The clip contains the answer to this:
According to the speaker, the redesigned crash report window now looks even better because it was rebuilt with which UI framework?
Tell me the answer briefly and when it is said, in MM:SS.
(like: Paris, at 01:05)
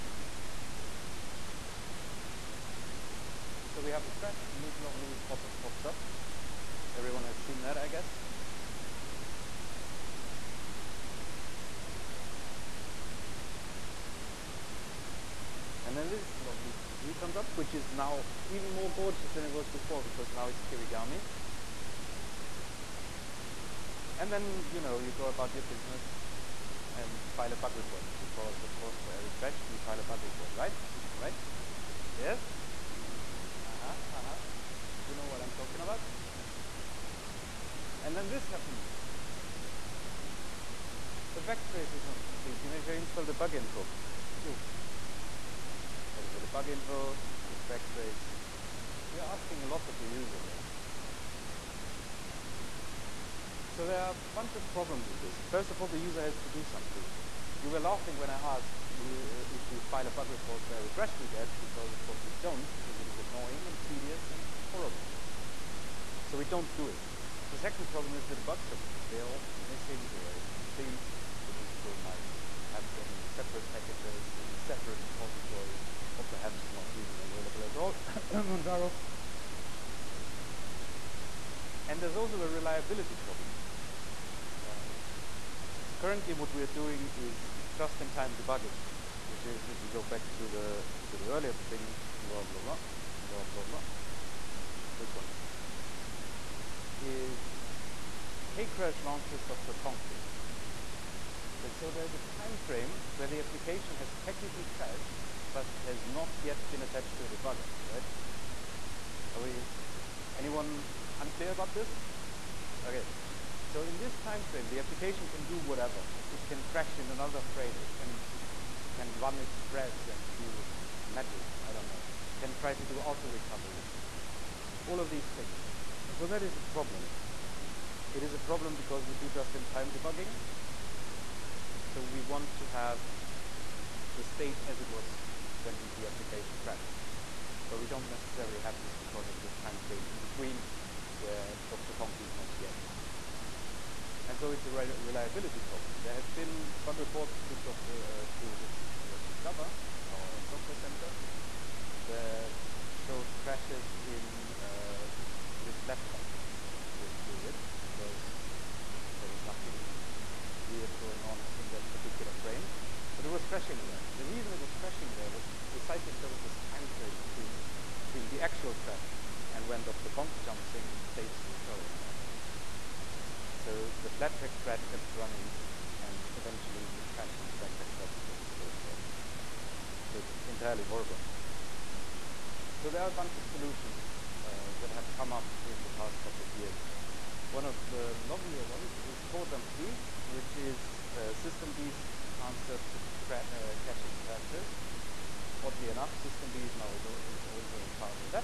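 Kirigami, at 00:20.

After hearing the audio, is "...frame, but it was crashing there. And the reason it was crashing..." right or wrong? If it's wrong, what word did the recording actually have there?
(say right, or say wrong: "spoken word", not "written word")
right.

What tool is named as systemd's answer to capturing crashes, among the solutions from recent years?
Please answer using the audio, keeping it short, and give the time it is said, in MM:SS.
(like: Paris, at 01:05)
Core Dump D, at 03:09.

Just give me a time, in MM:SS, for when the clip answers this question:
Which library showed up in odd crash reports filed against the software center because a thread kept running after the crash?
02:35.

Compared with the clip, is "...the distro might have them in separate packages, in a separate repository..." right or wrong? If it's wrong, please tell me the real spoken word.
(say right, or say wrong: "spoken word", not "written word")
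right.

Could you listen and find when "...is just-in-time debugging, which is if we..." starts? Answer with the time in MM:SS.
01:27.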